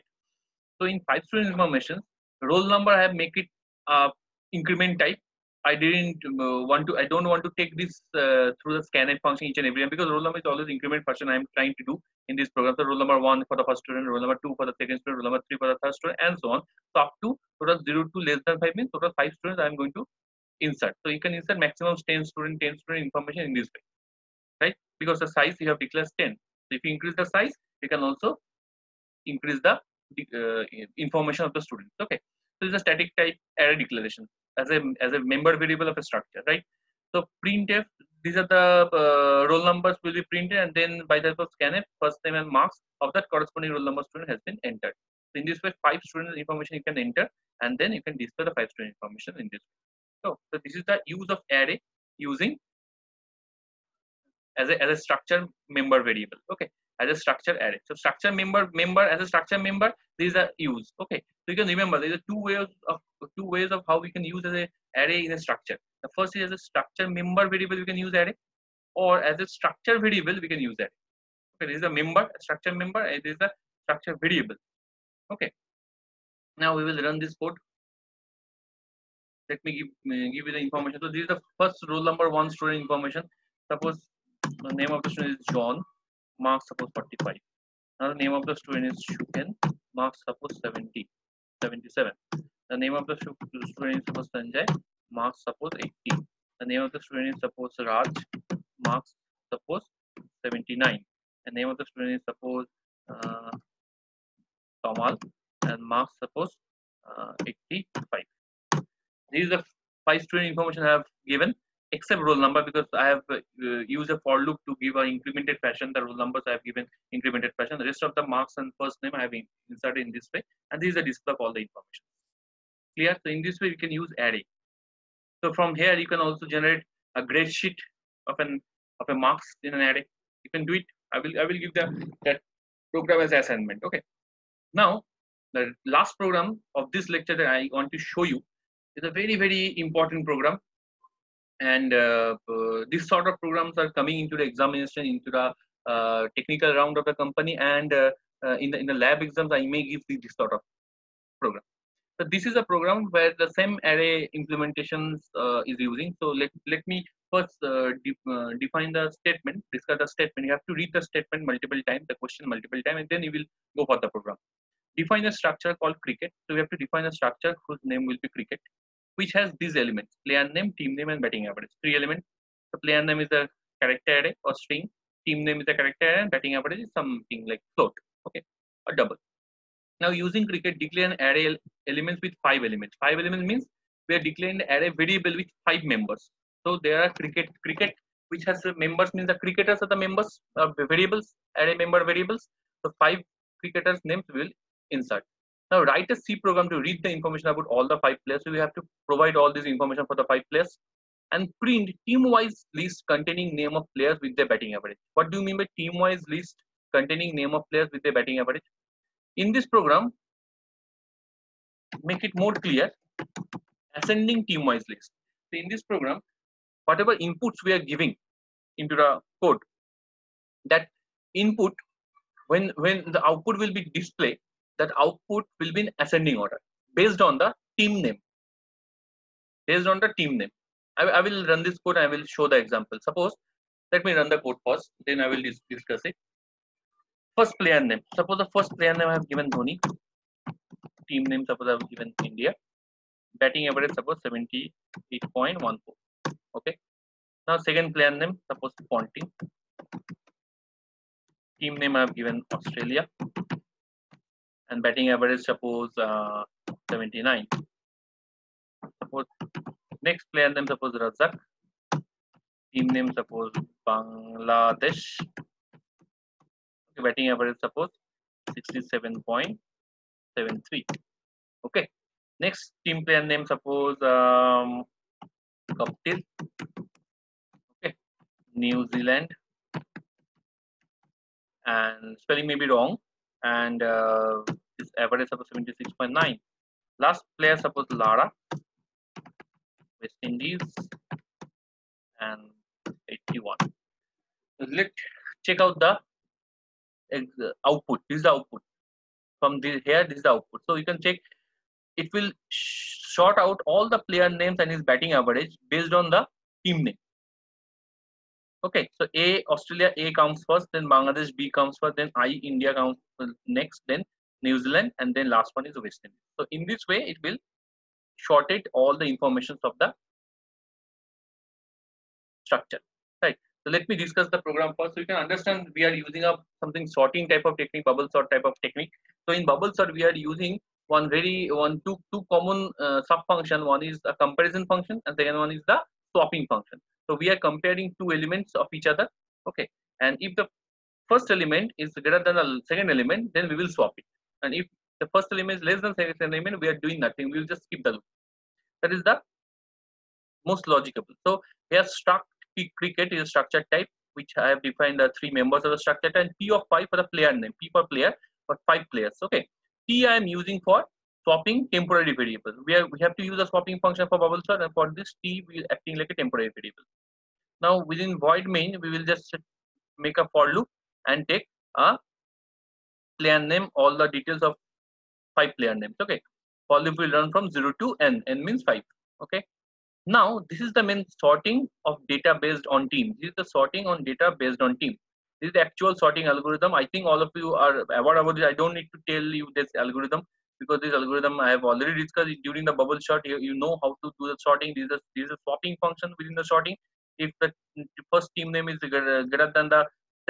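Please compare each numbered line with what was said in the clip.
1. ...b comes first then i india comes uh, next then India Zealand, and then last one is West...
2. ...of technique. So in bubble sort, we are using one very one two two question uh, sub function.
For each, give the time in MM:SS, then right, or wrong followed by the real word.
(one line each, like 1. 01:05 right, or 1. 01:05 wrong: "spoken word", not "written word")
1. 05:11 wrong: "New", not "India"
2. 05:28 wrong: "common", not "question".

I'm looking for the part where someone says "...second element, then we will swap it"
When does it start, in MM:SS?
05:42.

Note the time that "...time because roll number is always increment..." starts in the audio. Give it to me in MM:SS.
00:09.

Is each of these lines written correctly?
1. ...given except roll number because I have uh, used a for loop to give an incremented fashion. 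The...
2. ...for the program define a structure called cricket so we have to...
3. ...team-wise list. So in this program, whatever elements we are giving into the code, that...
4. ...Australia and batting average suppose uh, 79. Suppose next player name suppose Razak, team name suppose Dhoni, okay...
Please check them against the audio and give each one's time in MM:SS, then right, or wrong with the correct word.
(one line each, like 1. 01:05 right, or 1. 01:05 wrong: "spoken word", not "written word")
1. 01:51 right
2. 02:43 right
3. 03:34 wrong: "inputs", not "elements"
4. 04:12 wrong: "Bangladesh", not "Dhoni".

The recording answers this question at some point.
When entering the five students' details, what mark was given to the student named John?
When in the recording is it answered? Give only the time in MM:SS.
01:26.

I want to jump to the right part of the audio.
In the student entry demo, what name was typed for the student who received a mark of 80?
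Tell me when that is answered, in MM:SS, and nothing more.
01:34.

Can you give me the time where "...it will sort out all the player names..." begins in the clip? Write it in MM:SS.
05:02.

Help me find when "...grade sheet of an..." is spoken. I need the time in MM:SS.
02:07.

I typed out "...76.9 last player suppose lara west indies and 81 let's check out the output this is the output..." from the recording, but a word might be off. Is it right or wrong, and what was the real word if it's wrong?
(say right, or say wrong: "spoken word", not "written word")
right.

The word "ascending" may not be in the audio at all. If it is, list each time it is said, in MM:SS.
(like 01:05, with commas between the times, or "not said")
03:33, 03:45.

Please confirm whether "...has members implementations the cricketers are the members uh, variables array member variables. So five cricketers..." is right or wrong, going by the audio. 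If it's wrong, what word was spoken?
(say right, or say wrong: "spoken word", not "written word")
wrong: "means", not "implementations".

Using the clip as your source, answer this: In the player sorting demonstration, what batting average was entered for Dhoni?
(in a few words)
78.14.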